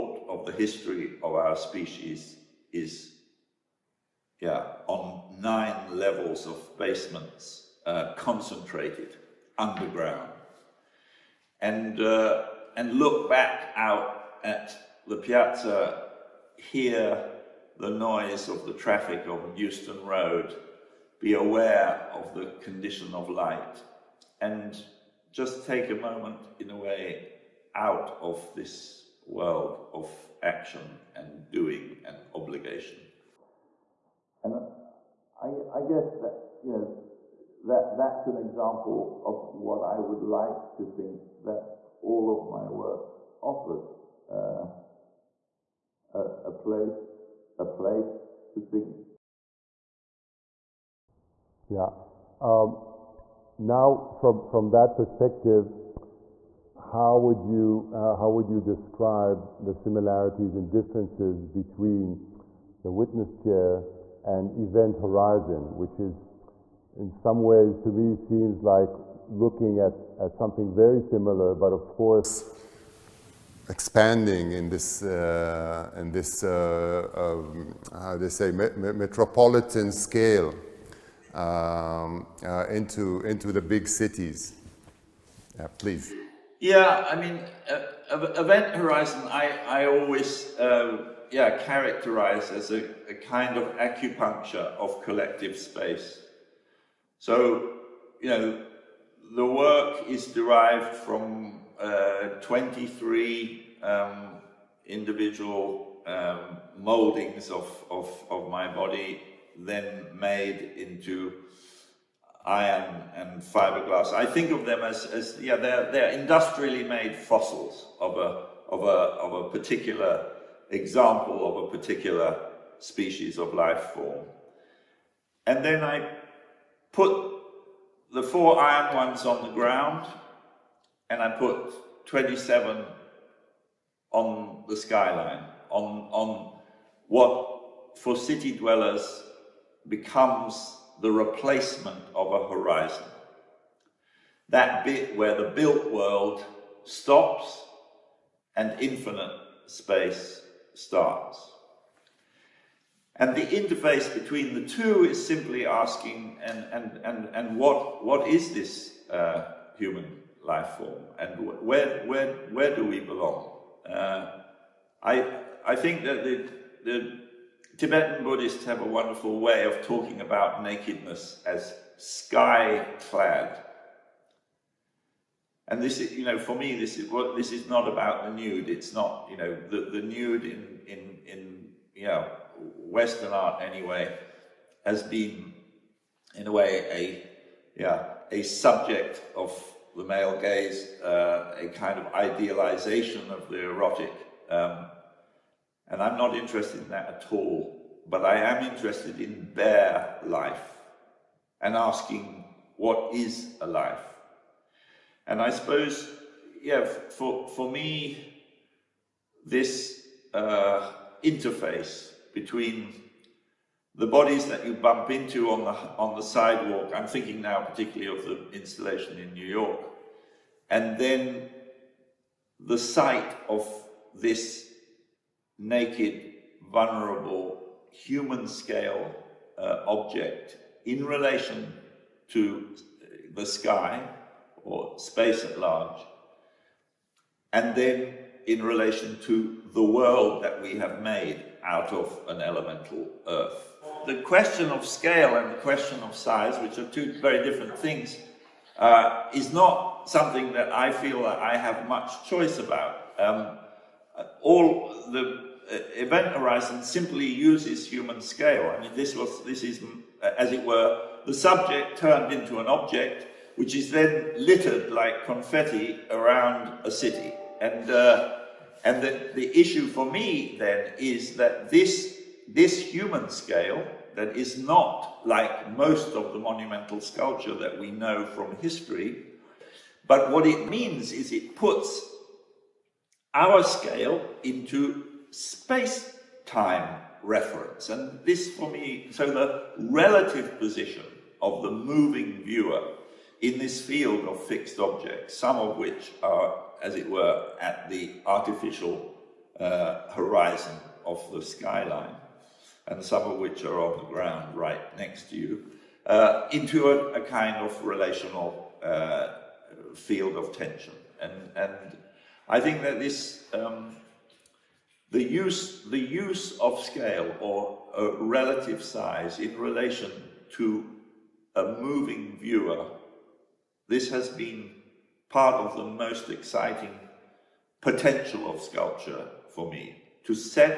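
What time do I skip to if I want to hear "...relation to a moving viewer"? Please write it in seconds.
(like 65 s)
319 s.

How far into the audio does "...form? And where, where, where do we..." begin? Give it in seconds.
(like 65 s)
160 s.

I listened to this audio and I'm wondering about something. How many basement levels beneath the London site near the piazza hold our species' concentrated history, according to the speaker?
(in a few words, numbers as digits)
9.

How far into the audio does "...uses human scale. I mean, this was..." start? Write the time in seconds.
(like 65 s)
257 s.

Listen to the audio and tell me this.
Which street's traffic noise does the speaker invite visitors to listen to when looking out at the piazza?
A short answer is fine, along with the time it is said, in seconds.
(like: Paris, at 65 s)
Euston Road, at 19 s.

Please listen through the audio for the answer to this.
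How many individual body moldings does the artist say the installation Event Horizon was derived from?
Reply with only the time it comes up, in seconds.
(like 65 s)
102 s.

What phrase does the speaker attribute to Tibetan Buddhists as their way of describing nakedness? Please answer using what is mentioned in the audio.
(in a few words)
sky clad.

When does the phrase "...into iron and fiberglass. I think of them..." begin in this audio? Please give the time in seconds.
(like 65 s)
110 s.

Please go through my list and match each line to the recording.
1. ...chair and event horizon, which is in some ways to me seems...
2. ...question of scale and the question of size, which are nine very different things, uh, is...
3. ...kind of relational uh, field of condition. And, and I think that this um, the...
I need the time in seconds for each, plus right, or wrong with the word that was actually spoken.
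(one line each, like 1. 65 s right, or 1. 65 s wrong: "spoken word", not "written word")
1. 63 s right
2. 244 s wrong: "two", not "nine"
3. 307 s wrong: "tension", not "condition".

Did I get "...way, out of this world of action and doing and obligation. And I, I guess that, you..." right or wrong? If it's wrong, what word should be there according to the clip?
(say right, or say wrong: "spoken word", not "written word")
right.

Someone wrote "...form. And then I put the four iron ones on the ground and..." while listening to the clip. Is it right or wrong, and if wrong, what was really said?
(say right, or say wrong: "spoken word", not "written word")
right.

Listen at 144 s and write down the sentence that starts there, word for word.
That bit where the built world stops and infinite space starts.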